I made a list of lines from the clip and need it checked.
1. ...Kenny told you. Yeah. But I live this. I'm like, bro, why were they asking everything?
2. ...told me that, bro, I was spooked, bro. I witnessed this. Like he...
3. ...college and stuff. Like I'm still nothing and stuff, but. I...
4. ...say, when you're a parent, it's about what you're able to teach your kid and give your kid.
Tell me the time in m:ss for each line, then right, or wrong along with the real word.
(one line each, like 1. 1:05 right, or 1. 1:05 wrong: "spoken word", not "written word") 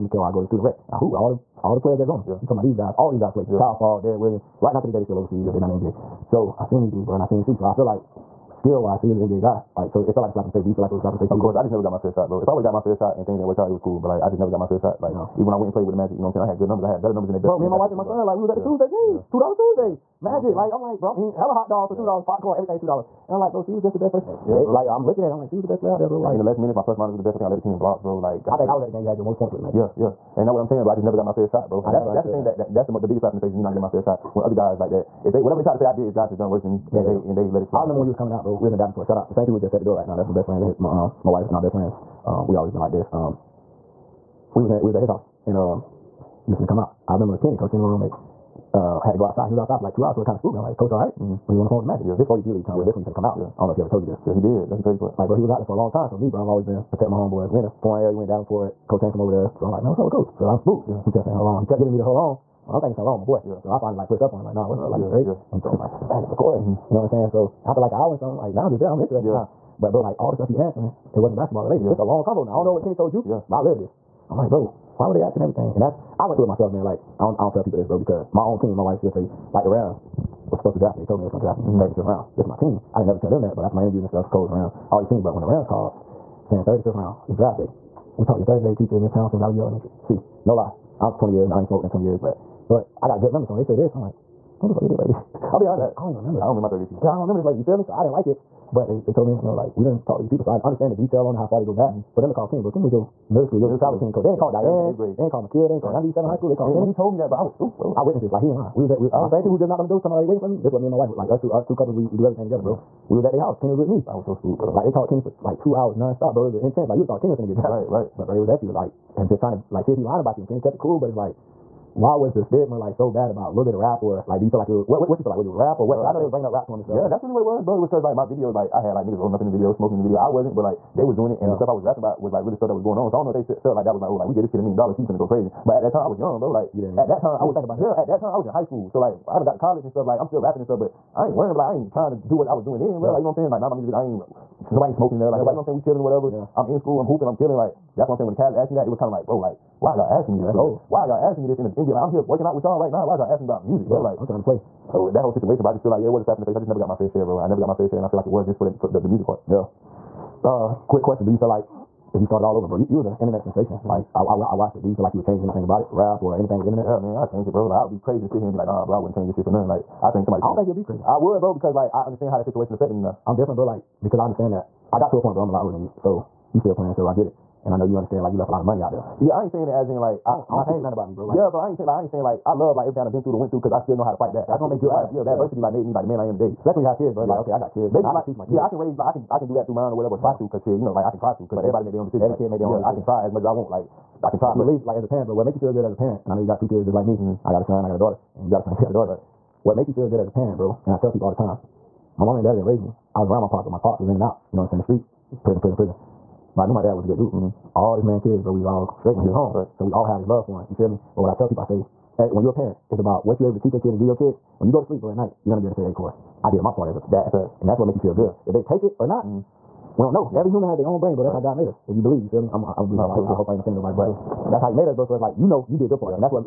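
1. 1:12 right
2. 1:46 right
3. 2:19 wrong: "rapping", not "nothing"
4. 3:31 right.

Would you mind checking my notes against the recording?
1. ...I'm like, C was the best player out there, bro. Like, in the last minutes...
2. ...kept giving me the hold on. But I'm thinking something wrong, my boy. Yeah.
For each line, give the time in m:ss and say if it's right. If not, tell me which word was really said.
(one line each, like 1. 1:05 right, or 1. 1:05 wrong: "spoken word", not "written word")
1. 0:25 right
2. 1:01 right.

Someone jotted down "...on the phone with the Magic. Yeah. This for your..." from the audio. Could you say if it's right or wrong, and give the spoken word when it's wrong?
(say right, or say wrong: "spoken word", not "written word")
right.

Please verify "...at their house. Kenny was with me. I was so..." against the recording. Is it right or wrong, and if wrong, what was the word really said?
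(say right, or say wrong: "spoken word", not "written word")
right.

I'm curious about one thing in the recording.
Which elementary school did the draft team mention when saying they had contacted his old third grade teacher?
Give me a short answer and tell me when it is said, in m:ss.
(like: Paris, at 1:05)
Valley View Elementary, at 1:29.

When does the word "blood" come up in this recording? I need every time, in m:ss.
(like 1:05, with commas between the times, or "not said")
not said.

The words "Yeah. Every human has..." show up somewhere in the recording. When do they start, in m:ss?
3:40.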